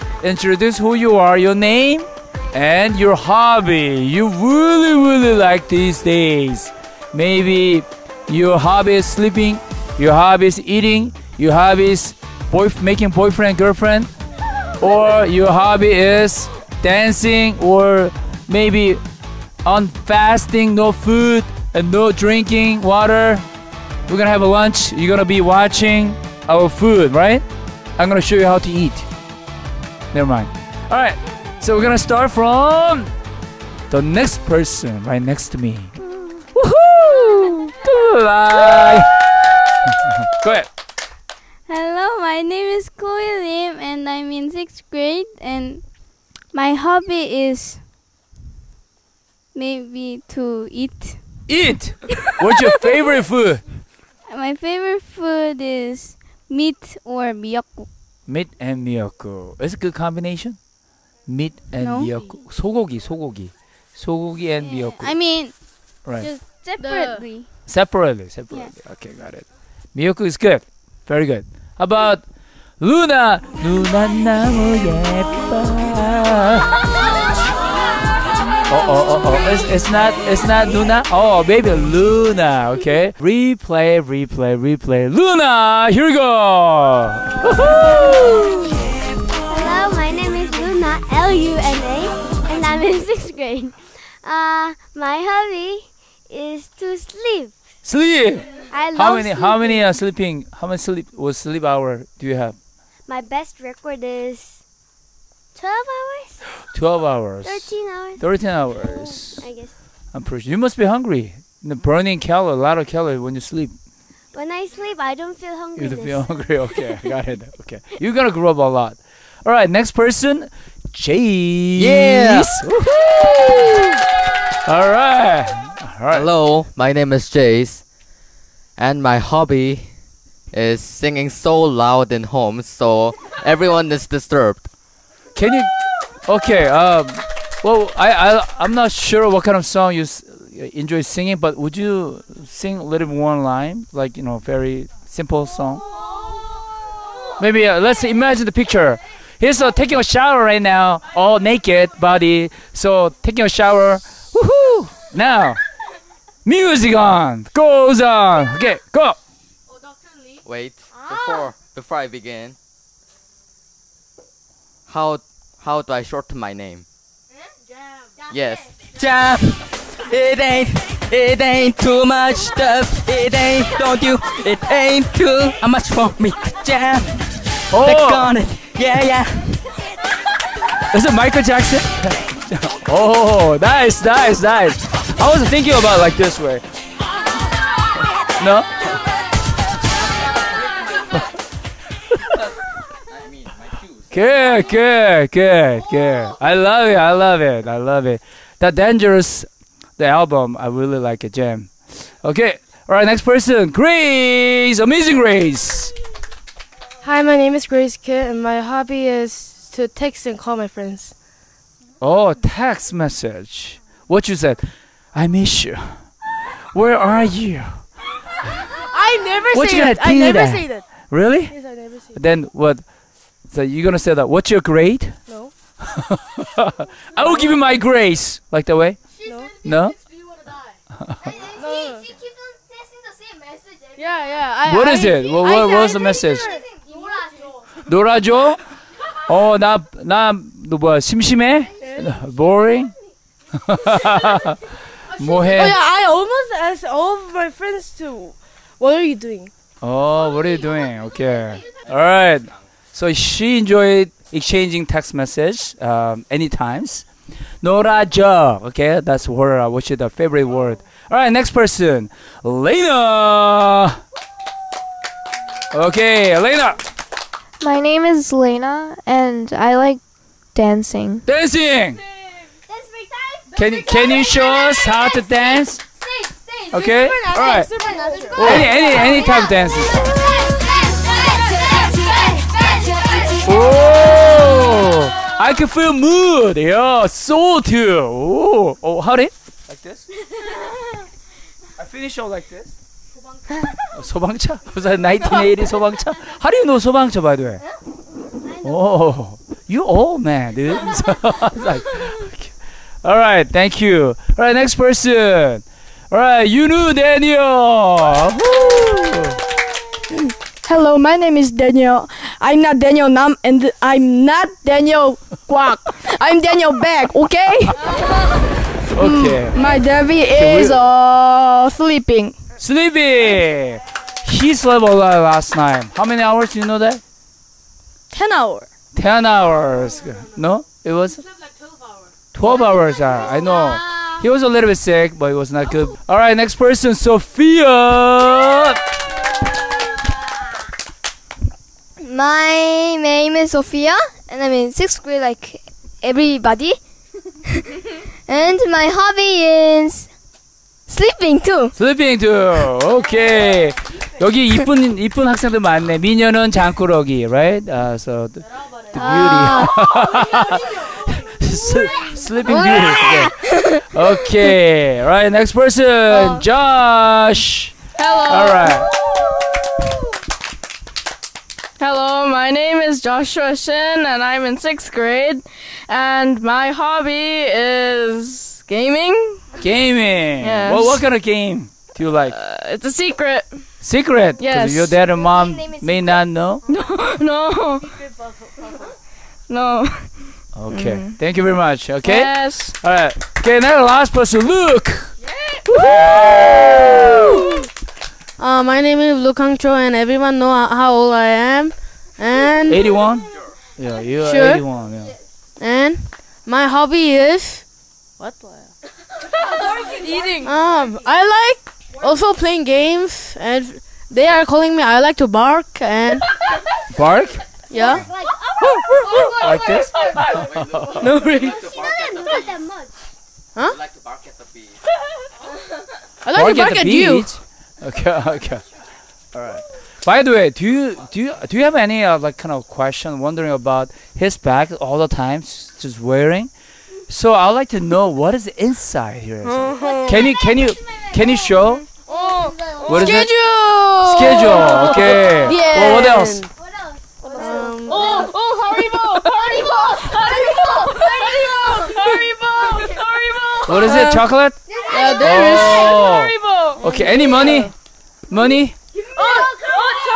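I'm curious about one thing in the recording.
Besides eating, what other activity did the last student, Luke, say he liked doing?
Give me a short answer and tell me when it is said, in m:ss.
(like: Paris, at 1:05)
Playing games, at 6:52.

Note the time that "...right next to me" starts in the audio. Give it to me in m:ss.
0:35.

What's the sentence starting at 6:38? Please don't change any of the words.
Uh, my name is Lukang Cho, and everyone know how old I am.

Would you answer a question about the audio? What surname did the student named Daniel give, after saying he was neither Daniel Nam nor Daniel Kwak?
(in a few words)
Beck.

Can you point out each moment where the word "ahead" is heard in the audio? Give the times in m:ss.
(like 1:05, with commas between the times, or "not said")
0:40.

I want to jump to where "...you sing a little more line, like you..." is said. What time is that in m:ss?
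2:21.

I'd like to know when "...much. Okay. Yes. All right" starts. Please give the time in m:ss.
6:31.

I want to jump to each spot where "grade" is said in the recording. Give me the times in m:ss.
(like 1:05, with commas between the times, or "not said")
0:44, 1:33, 3:44, 5:45, 6:14.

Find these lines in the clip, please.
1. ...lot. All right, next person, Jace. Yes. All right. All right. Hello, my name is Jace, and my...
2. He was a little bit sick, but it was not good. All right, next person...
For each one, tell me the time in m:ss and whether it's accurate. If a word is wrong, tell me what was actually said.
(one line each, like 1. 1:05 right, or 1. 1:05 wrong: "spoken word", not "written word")
1. 1:58 right
2. 5:34 right.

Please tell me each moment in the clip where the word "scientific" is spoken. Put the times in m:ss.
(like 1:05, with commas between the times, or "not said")
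not said.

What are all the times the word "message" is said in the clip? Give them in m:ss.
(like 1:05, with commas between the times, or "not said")
3:32, 3:55, 4:15.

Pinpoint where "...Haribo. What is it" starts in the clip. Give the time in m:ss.
7:33.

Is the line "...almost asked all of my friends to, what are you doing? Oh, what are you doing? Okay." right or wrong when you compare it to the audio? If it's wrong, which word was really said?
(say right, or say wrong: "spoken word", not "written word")
right.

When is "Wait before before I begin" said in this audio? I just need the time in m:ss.
2:40.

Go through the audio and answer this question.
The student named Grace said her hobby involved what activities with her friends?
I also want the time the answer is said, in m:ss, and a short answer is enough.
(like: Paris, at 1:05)
Text and call, at 3:29.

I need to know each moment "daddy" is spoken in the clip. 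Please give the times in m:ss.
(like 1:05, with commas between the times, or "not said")
5:19.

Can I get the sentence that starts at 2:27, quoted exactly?
Maybe uh, let's imagine the picture.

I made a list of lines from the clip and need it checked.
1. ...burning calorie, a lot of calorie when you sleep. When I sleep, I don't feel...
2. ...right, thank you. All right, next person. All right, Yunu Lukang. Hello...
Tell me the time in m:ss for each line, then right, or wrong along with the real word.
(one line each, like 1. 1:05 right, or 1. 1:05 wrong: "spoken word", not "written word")
1. 1:51 right
2. 5:03 wrong: "Daniel", not "Lukang".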